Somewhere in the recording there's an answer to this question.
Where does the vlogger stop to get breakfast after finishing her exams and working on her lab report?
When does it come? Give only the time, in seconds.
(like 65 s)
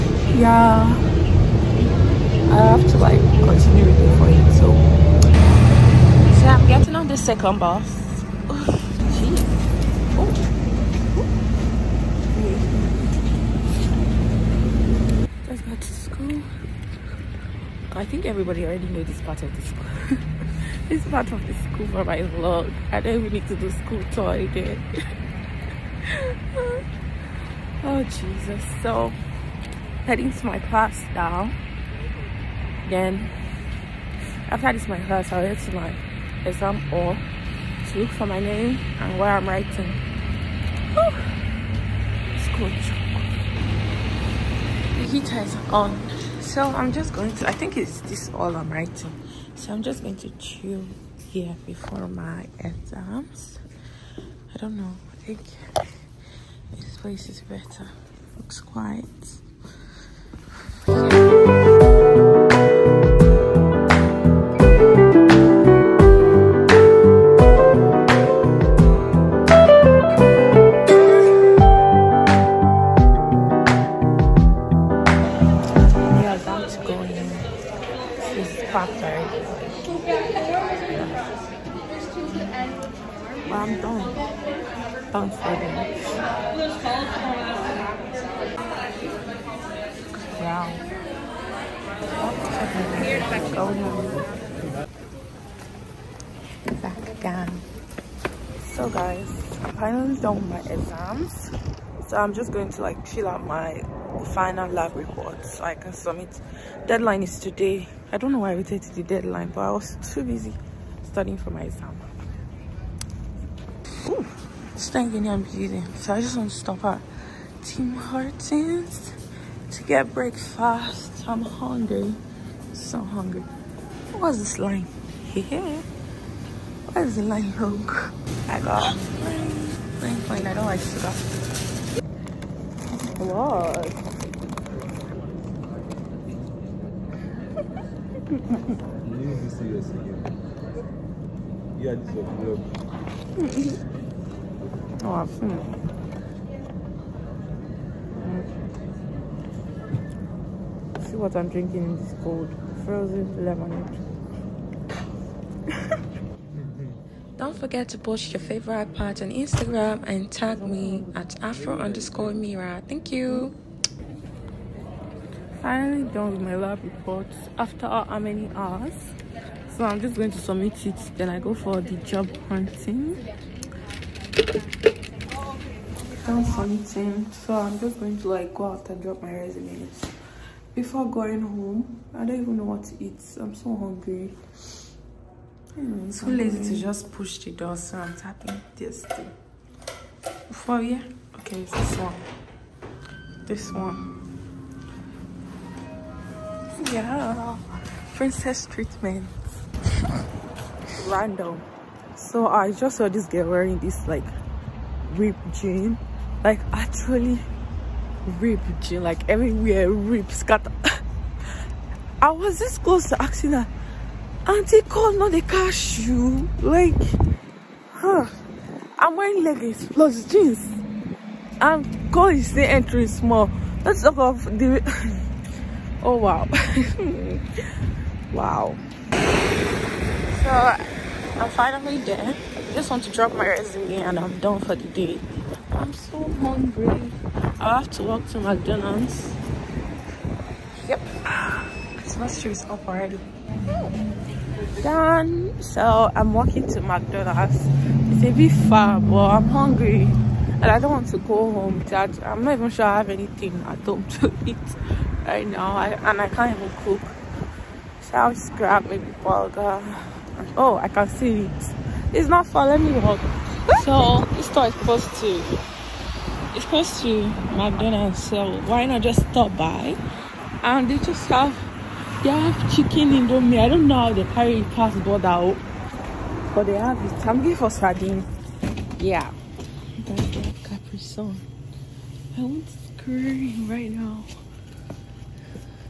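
117 s.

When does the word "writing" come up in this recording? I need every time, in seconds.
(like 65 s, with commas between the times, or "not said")
39 s, 48 s.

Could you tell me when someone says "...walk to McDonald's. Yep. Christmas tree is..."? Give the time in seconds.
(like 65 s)
238 s.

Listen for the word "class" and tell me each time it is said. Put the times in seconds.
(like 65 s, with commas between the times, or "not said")
30 s, 35 s.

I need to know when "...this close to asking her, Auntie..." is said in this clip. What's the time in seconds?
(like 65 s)
212 s.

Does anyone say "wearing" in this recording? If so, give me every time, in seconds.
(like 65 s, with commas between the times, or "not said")
203 s, 219 s.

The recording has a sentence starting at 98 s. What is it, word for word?
So guys, I'm finally done with my exams.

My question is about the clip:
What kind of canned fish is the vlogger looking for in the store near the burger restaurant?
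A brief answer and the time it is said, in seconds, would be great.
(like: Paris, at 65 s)
Sardine, at 277 s.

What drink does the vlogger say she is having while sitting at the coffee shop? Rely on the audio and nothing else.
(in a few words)
Frozen lemonade.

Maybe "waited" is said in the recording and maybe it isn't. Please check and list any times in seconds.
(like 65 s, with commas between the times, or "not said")
108 s.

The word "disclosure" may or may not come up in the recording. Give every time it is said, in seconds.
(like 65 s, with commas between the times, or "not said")
not said.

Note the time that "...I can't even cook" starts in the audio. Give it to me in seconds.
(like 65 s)
256 s.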